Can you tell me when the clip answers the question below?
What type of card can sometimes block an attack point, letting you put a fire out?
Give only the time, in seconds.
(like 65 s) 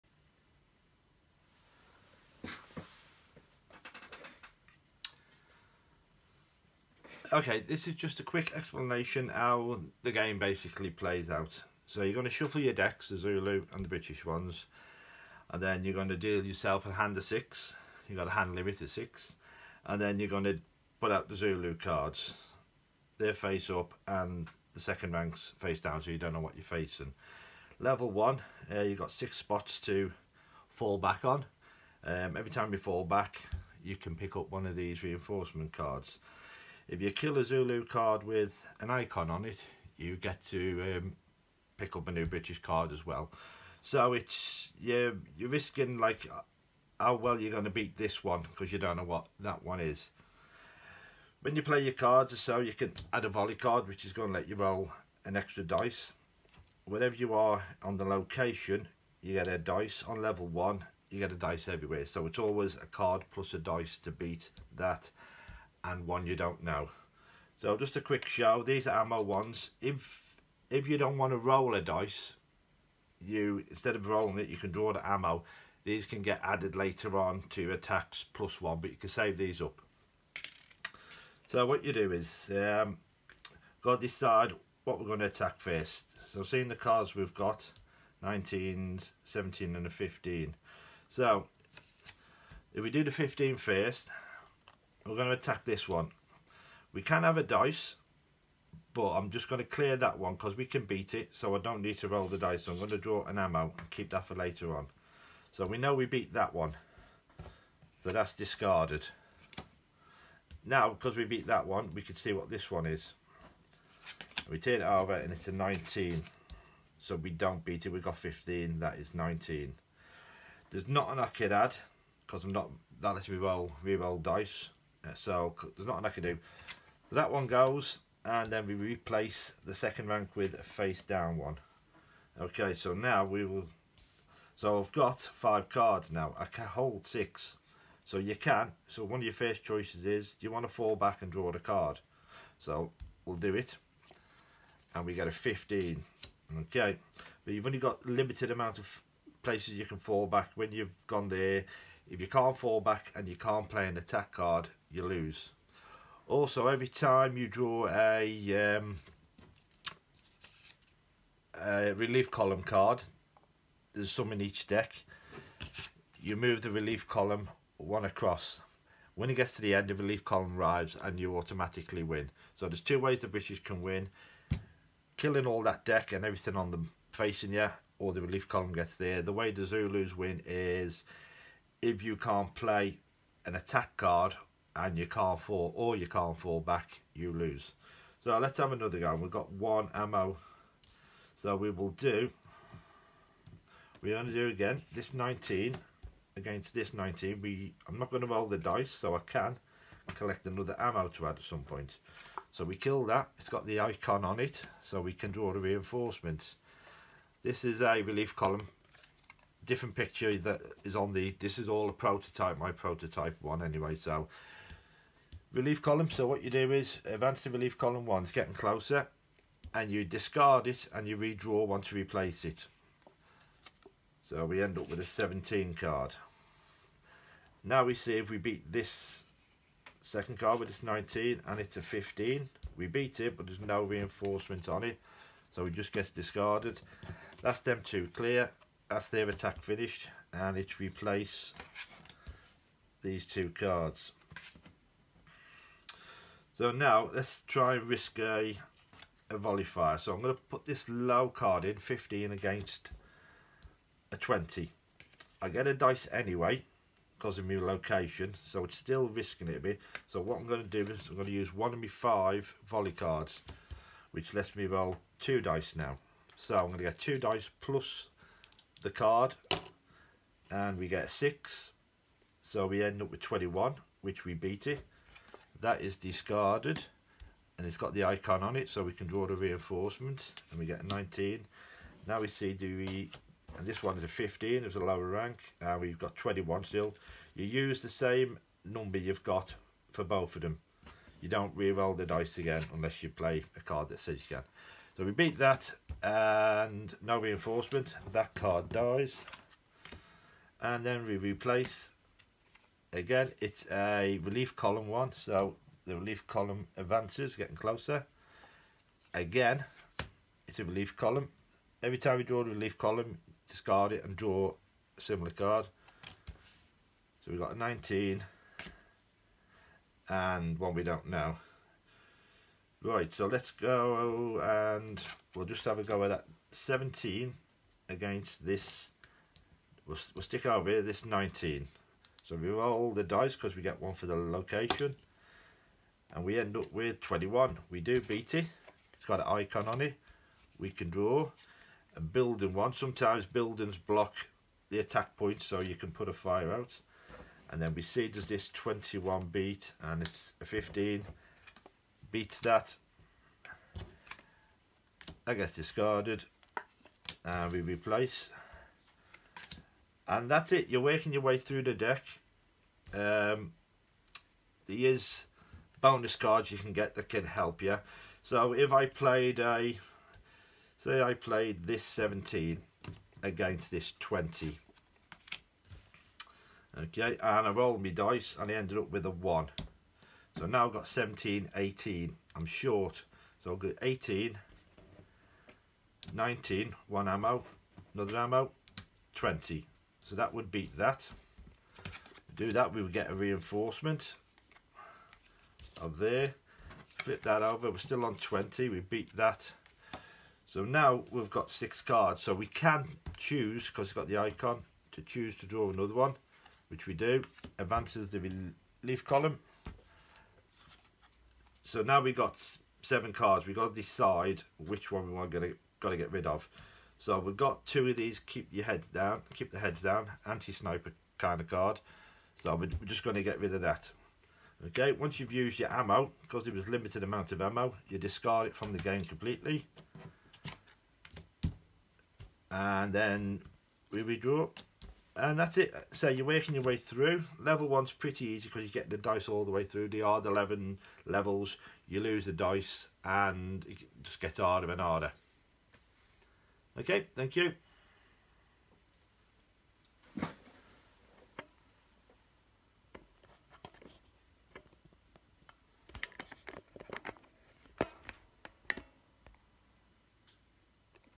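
342 s.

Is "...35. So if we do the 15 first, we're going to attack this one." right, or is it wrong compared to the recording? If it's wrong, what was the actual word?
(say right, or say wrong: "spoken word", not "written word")
wrong: "15", not "35".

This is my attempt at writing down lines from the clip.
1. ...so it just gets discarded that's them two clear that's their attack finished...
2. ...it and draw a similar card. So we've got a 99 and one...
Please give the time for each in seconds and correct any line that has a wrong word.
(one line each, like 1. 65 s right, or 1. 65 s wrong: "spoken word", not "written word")
1. 235 s right
2. 313 s wrong: "19", not "99".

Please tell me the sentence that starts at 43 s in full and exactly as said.
So it's you're, you're risking like how well you're going to beat this one because you don't know what that one is.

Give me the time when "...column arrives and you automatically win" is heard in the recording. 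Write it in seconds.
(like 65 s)
170 s.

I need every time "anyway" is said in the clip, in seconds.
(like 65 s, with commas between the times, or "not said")
213 s, 256 s.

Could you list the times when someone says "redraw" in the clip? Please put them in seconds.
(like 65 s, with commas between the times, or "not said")
221 s, 434 s.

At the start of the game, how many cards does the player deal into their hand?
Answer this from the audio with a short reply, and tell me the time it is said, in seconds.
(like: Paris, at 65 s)
6, at 16 s.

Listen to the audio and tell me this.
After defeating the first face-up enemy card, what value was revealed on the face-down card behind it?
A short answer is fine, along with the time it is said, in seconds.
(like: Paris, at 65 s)
19, at 115 s.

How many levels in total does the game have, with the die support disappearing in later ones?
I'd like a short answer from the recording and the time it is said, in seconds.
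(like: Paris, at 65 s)
11, at 440 s.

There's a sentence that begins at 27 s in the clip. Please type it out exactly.
Level one, uh, you've got six spots to fall back on.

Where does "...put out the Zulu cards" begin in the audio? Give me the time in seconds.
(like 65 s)
20 s.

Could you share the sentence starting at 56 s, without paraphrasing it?
Wherever you are on the location, you get a dice on level one, you get a dice everywhere.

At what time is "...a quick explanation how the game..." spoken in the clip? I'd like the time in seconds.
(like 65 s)
8 s.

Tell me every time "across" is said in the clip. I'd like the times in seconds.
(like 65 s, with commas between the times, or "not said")
168 s.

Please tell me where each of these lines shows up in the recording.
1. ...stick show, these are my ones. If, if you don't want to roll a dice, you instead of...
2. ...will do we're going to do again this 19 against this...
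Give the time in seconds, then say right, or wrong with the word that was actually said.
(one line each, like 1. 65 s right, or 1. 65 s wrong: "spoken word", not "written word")
1. 68 s wrong: "quick", not "stick"
2. 191 s right.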